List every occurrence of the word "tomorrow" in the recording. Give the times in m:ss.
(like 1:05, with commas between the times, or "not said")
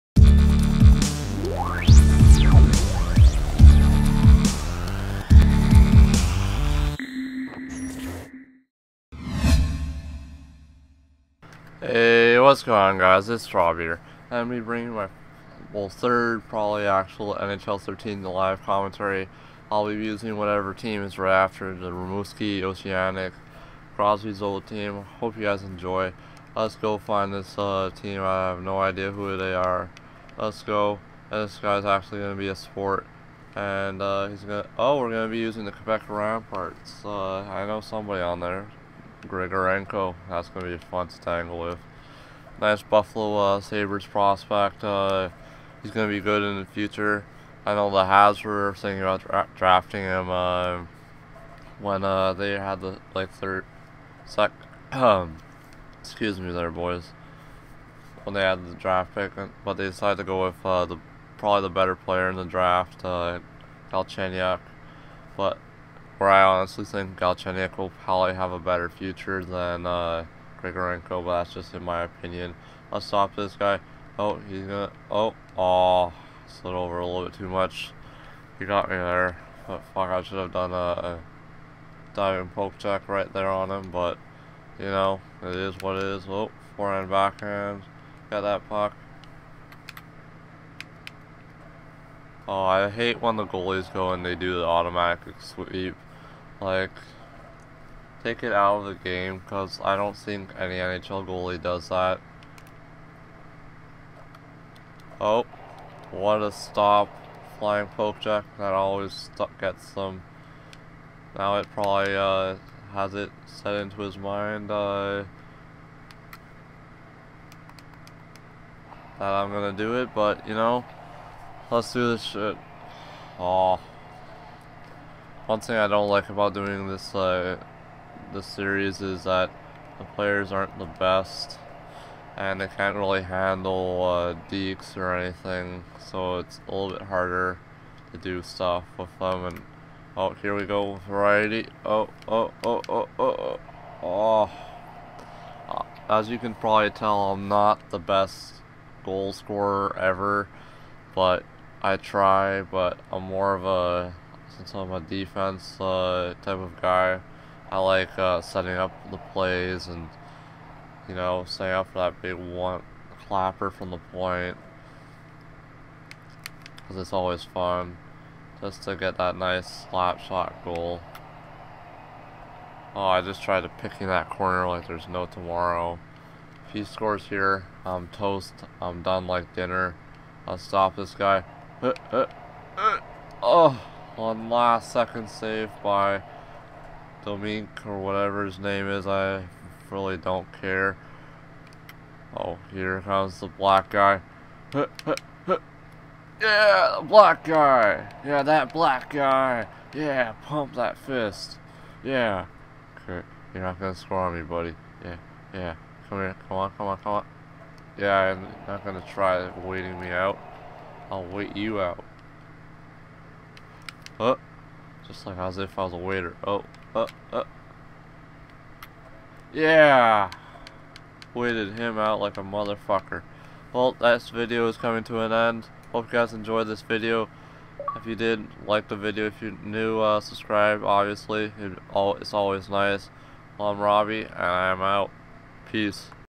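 2:55.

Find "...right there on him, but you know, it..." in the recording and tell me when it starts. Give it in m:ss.
1:23.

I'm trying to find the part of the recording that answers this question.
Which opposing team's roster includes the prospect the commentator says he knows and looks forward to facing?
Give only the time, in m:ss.
0:35.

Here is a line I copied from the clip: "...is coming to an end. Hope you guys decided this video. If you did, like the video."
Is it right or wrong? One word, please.
wrong.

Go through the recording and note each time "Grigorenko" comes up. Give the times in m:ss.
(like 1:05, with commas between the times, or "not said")
0:39, 1:10.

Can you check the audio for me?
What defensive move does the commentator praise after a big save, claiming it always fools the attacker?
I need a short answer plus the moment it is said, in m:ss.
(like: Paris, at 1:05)
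Flying poke check, at 1:47.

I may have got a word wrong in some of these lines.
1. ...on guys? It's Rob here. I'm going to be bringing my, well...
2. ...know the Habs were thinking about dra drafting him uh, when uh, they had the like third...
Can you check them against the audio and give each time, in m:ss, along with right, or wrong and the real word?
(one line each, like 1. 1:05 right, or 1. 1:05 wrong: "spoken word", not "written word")
1. 0:12 right
2. 0:47 right.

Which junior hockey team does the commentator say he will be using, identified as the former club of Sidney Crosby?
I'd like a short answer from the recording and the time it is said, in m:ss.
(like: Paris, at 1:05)
Rimouski Oceanic, at 0:21.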